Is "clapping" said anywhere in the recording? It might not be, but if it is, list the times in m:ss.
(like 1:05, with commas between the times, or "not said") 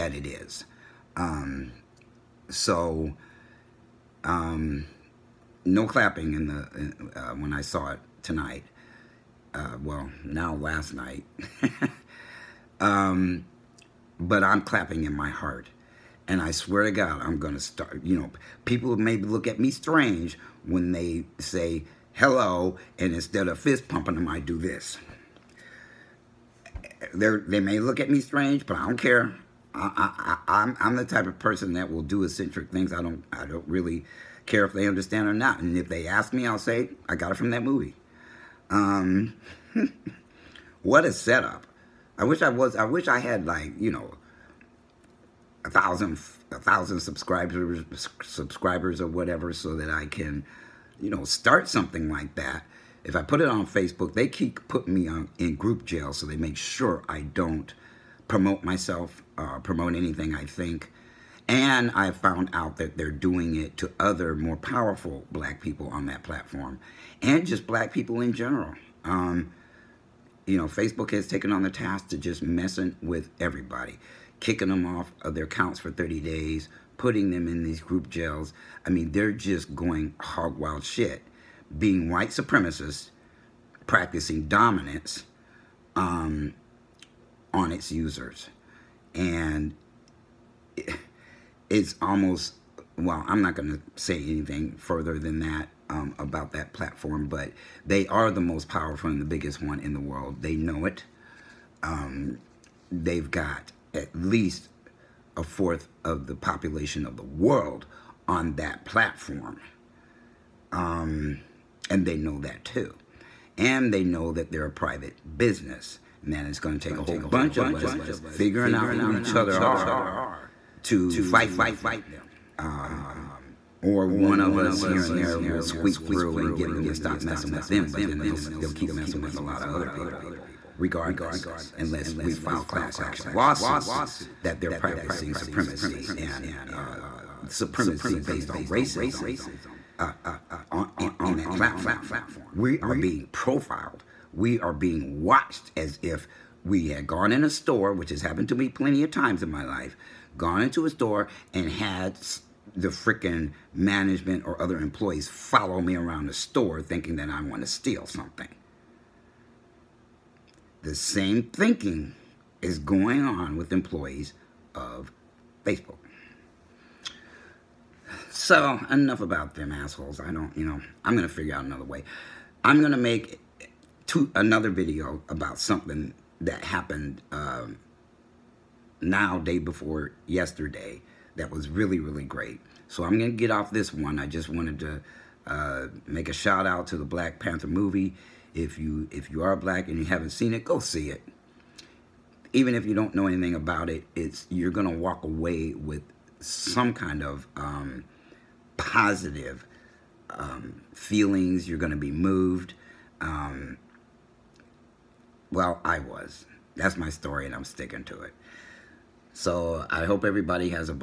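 0:05, 0:14.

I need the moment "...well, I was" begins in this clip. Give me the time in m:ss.
3:25.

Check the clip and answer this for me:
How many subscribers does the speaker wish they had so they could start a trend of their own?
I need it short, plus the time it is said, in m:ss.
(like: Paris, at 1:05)
1000, at 0:46.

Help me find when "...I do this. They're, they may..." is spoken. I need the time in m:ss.
0:24.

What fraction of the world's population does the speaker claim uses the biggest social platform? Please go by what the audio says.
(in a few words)
a fourth.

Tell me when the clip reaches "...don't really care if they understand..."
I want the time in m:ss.
0:33.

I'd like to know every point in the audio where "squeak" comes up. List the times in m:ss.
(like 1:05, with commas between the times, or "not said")
2:05.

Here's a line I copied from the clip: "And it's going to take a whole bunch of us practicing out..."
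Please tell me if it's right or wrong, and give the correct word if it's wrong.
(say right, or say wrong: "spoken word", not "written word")
wrong: "figuring", not "practicing".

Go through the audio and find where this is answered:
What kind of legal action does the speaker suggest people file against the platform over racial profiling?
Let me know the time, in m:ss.
2:12.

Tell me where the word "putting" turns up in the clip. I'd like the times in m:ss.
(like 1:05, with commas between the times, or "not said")
0:54, 1:16.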